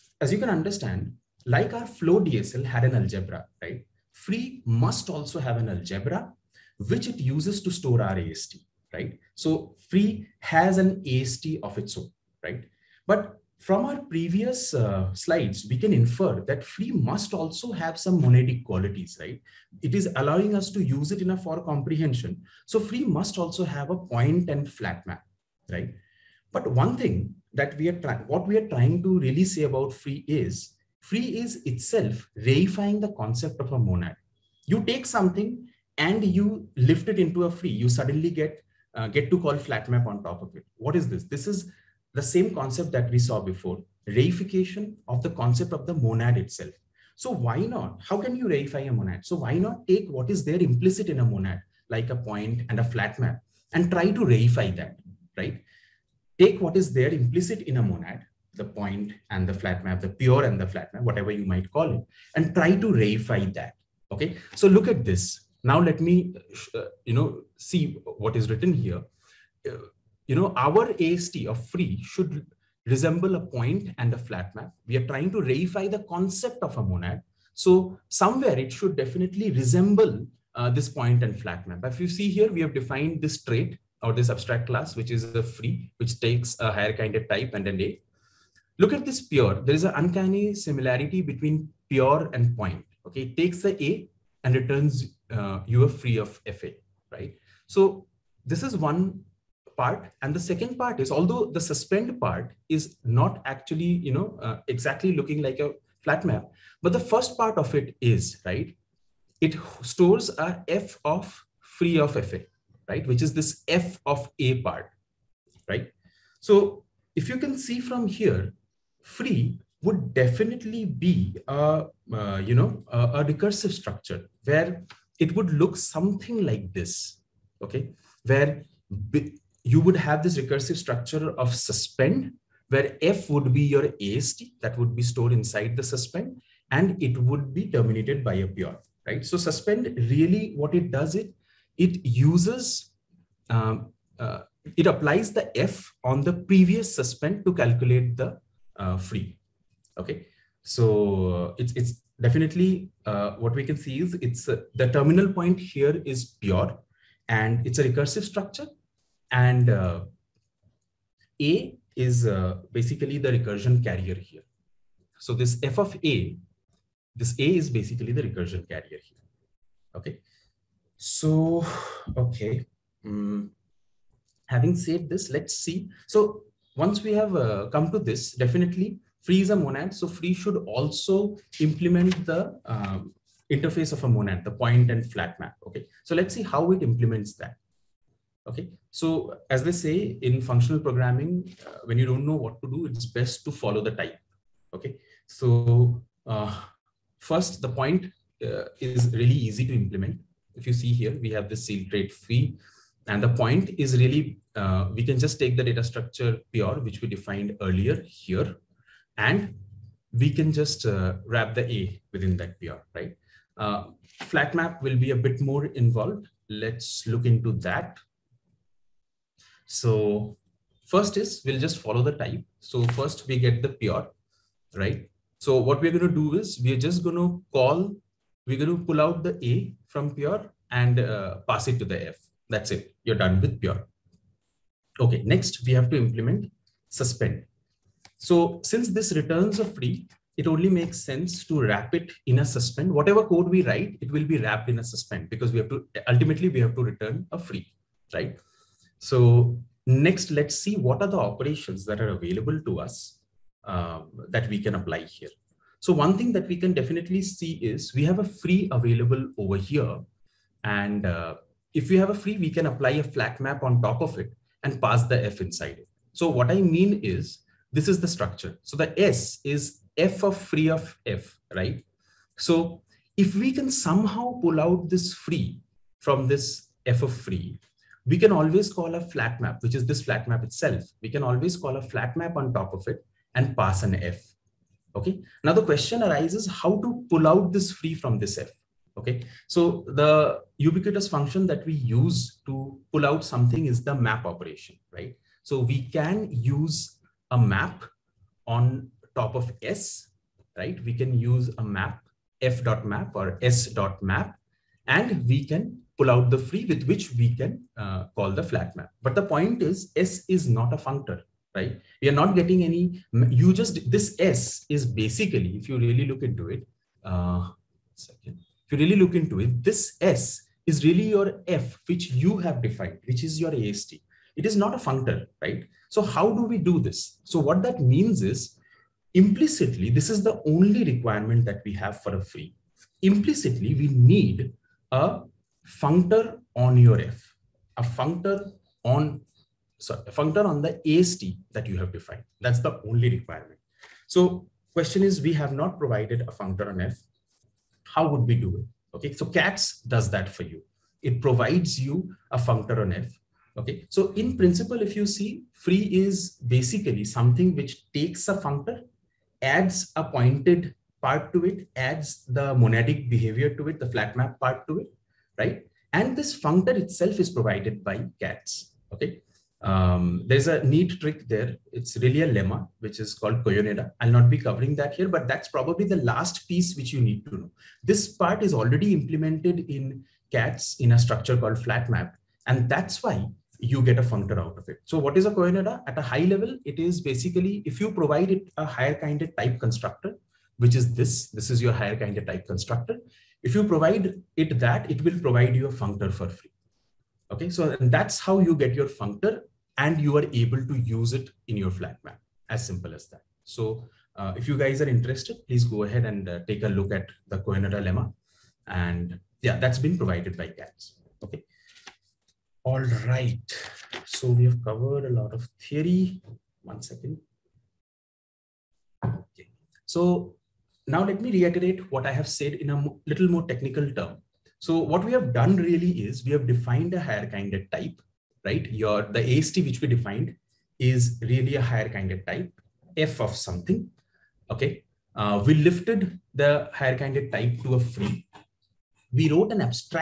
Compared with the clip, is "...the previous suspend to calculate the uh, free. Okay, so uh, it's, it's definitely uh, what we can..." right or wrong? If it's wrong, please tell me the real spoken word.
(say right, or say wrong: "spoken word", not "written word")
right.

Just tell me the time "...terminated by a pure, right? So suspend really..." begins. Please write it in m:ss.
2:17.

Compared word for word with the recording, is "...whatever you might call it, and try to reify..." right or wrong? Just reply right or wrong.
right.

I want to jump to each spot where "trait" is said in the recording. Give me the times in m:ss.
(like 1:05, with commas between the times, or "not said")
1:23, 3:21.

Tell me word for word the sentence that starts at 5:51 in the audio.
It provides you a functor on F.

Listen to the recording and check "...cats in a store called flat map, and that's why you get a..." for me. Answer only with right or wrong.
wrong.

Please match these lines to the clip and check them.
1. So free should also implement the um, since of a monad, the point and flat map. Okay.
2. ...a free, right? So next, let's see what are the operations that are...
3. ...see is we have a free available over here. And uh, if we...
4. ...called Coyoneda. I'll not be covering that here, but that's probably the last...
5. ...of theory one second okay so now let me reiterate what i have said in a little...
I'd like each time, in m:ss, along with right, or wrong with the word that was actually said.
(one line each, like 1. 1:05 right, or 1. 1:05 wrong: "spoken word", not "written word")
1. 2:59 wrong: "interface", not "since"
2. 4:07 right
3. 4:17 right
4. 6:13 right
5. 6:55 right.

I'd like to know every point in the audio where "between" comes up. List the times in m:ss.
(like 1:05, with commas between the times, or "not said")
1:31.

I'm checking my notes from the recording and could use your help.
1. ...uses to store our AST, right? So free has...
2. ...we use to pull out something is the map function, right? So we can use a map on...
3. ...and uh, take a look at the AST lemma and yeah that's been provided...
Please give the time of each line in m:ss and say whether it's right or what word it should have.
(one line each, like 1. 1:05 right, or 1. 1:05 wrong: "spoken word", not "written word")
1. 0:07 right
2. 4:51 wrong: "operation", not "function"
3. 6:46 wrong: "Coyoneda", not "AST".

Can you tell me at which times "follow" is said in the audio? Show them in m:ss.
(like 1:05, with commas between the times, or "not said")
3:13, 3:41.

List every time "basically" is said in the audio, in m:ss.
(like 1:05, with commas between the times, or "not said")
2:42, 2:47, 5:14, 5:56, 6:27.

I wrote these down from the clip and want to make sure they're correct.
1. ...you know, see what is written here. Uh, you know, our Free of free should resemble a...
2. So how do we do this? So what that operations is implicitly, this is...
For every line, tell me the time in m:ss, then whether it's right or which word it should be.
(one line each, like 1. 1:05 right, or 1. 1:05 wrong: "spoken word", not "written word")
1. 1:07 wrong: "AST", not "Free"
2. 5:25 wrong: "means", not "operations".